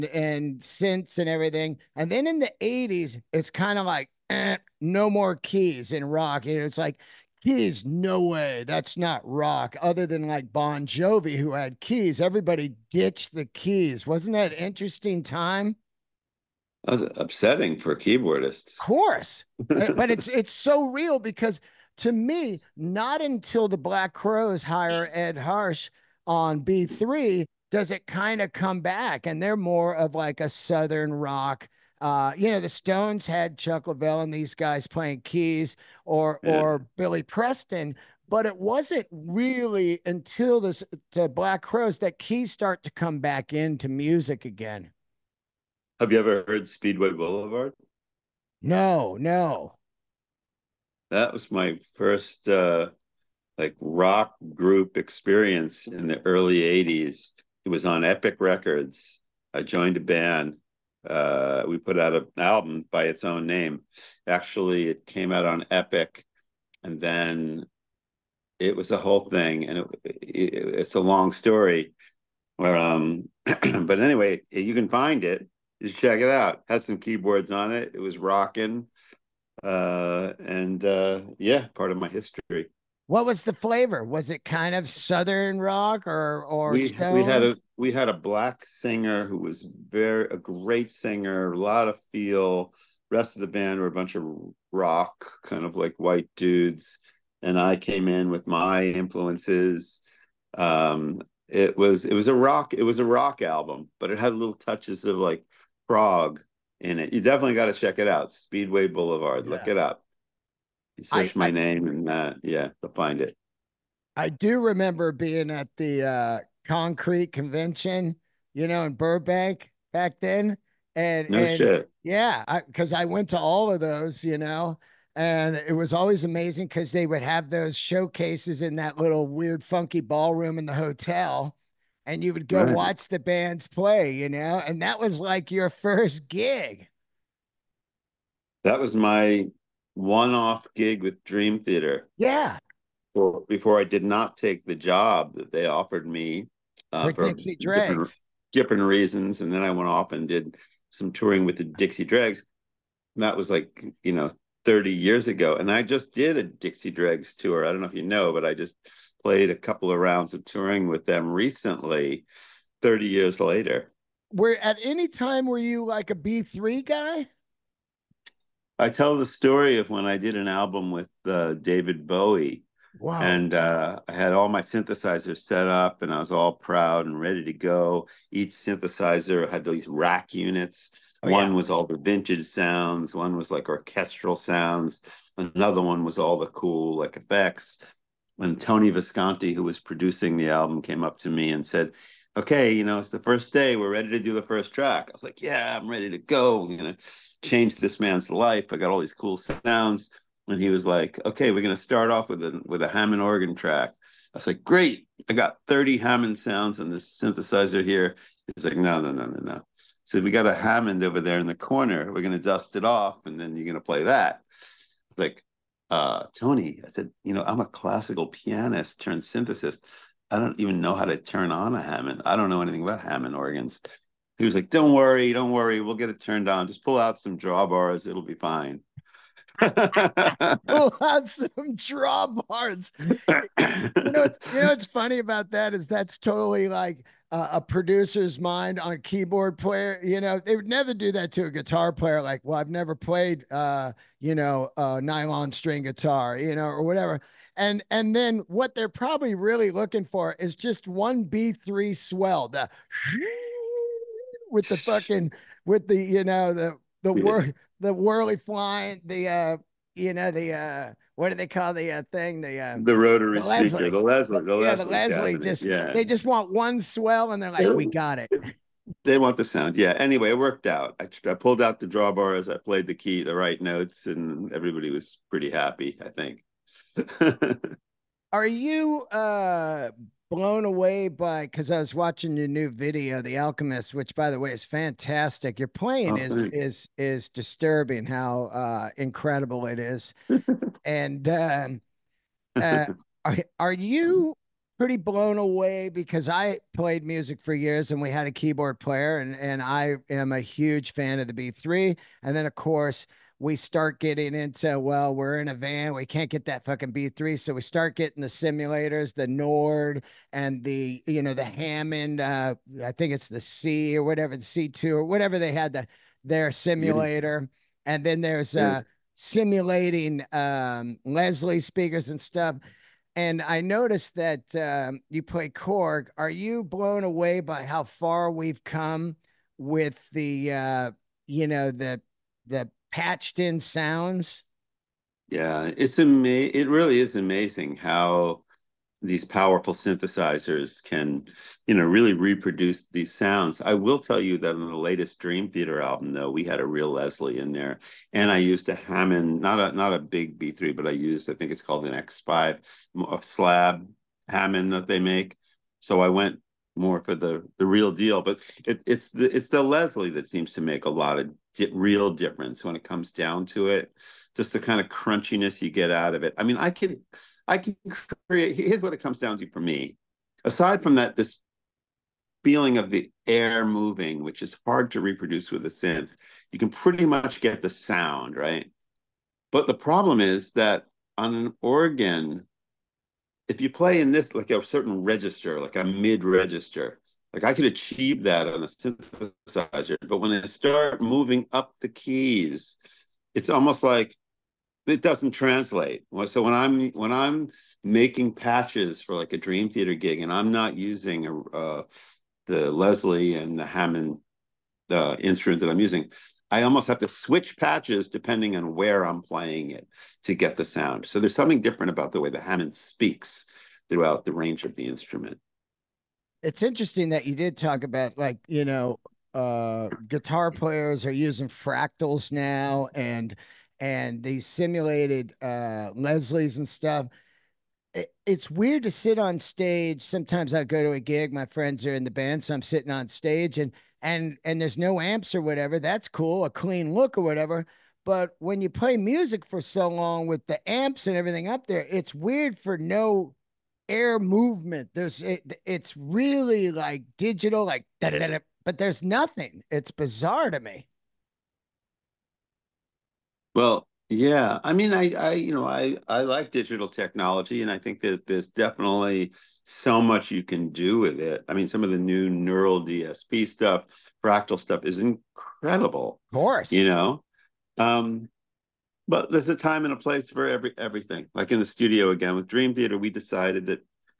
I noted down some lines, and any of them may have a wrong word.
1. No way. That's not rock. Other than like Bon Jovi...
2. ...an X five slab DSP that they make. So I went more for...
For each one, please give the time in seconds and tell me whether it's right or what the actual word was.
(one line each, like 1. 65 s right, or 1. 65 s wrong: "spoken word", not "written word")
1. 7 s right
2. 351 s wrong: "Hammond", not "DSP".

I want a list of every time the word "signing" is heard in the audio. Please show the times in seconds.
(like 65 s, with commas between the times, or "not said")
not said.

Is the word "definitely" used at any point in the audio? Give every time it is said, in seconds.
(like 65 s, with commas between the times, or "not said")
107 s, 458 s.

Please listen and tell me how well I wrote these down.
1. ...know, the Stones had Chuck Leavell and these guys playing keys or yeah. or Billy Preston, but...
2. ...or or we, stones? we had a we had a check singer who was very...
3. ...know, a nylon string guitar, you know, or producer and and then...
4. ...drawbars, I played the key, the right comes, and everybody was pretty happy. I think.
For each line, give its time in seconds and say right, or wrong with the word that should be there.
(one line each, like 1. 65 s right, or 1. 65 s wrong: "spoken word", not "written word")
1. 32 s right
2. 86 s wrong: "black", not "check"
3. 244 s wrong: "whatever", not "producer"
4. 271 s wrong: "notes", not "comes".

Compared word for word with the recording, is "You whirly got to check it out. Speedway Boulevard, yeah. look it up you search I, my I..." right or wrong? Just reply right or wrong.
wrong.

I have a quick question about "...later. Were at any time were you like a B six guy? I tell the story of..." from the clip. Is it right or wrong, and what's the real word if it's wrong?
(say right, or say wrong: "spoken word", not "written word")
wrong: "three", not "six".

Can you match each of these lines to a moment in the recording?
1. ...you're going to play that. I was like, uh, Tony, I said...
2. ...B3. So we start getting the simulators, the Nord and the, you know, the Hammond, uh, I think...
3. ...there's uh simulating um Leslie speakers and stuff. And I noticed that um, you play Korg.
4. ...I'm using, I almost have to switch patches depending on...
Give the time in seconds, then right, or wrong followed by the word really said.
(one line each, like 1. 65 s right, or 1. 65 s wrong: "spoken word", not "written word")
1. 213 s right
2. 306 s right
3. 318 s right
4. 405 s right.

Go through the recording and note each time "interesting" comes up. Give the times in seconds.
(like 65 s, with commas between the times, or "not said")
14 s, 416 s.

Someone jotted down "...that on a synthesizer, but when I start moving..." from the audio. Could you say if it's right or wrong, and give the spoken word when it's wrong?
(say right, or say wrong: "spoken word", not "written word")
right.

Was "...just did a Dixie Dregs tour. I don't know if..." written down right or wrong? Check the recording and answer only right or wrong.
right.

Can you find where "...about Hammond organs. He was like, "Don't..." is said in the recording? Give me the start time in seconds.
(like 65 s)
222 s.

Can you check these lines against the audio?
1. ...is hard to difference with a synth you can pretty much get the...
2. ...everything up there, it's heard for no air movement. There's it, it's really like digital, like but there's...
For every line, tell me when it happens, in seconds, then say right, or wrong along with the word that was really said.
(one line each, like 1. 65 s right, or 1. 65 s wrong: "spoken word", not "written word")
1. 374 s wrong: "reproduce", not "difference"
2. 441 s wrong: "weird", not "heard".